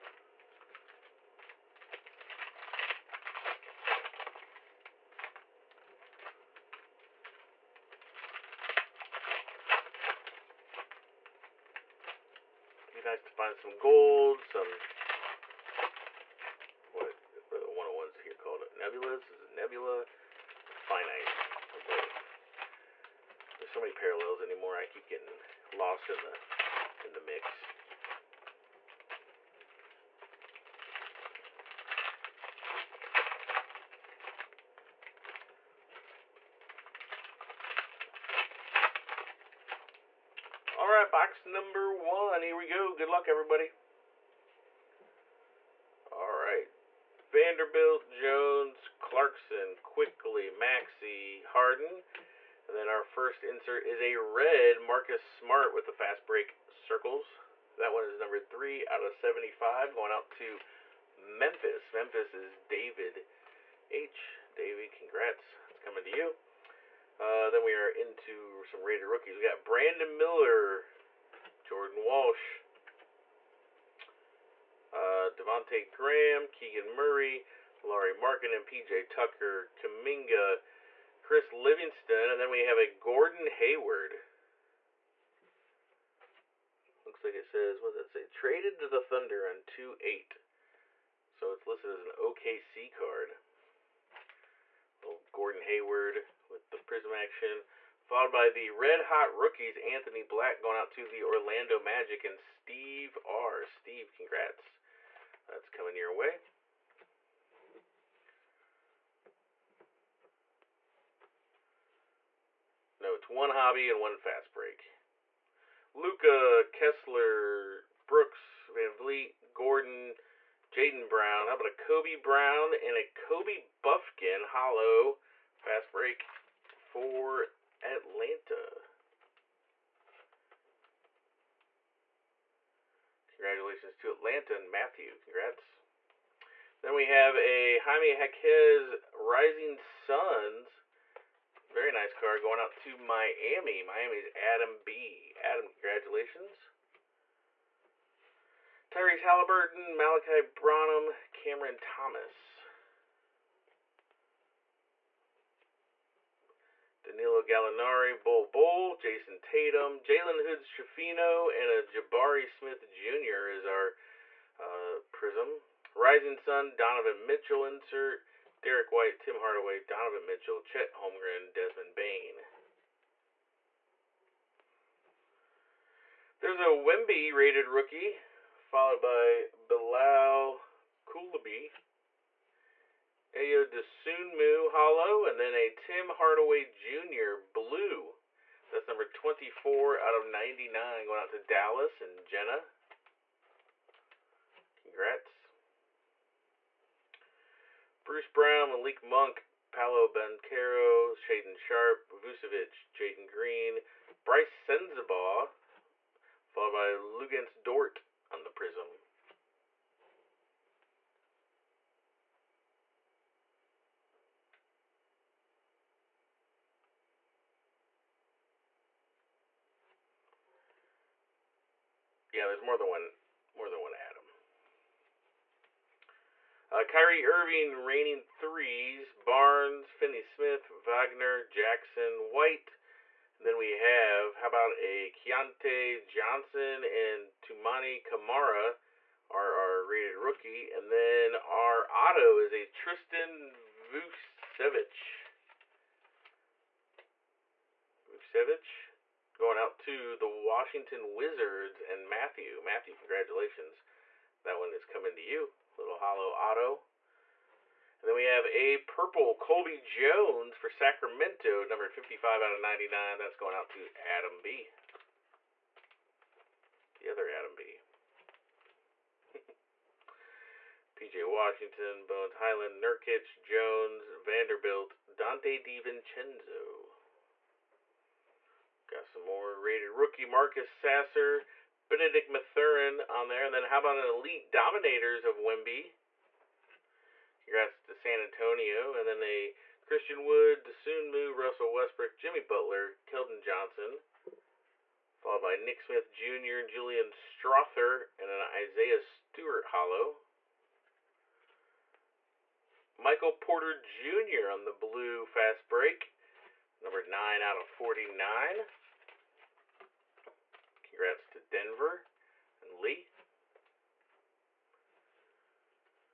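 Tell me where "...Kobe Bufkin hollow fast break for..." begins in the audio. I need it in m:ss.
2:03.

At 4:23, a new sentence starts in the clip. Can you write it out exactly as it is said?
That's going out to Adam B.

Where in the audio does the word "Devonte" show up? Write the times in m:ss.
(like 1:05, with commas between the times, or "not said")
1:15.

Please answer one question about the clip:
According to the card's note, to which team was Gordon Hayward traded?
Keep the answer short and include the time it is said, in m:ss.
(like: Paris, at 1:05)
Thunder, at 1:29.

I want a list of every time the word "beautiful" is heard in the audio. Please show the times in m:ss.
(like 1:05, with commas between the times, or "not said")
not said.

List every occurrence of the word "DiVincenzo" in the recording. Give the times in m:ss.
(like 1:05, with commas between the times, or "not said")
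4:35.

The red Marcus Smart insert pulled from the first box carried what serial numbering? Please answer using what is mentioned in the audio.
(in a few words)
3 out of 75.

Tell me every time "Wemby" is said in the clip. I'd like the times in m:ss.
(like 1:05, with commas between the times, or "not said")
2:56, 4:45.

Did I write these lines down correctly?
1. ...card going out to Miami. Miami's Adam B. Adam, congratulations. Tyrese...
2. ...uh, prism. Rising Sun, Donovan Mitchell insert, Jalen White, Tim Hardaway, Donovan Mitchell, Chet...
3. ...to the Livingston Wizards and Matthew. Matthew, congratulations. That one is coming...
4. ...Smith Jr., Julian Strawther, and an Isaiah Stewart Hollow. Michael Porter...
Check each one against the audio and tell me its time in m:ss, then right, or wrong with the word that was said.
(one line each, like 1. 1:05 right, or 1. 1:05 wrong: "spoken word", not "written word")
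1. 2:22 right
2. 2:44 wrong: "Derrick", not "Jalen"
3. 4:09 wrong: "Washington", not "Livingston"
4. 4:55 right.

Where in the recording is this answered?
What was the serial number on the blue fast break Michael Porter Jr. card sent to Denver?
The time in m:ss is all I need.
5:06.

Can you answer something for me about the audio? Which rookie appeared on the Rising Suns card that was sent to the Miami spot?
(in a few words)
Jaime Jaquez.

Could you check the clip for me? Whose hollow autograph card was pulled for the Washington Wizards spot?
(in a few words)
Tristan Vukcevic.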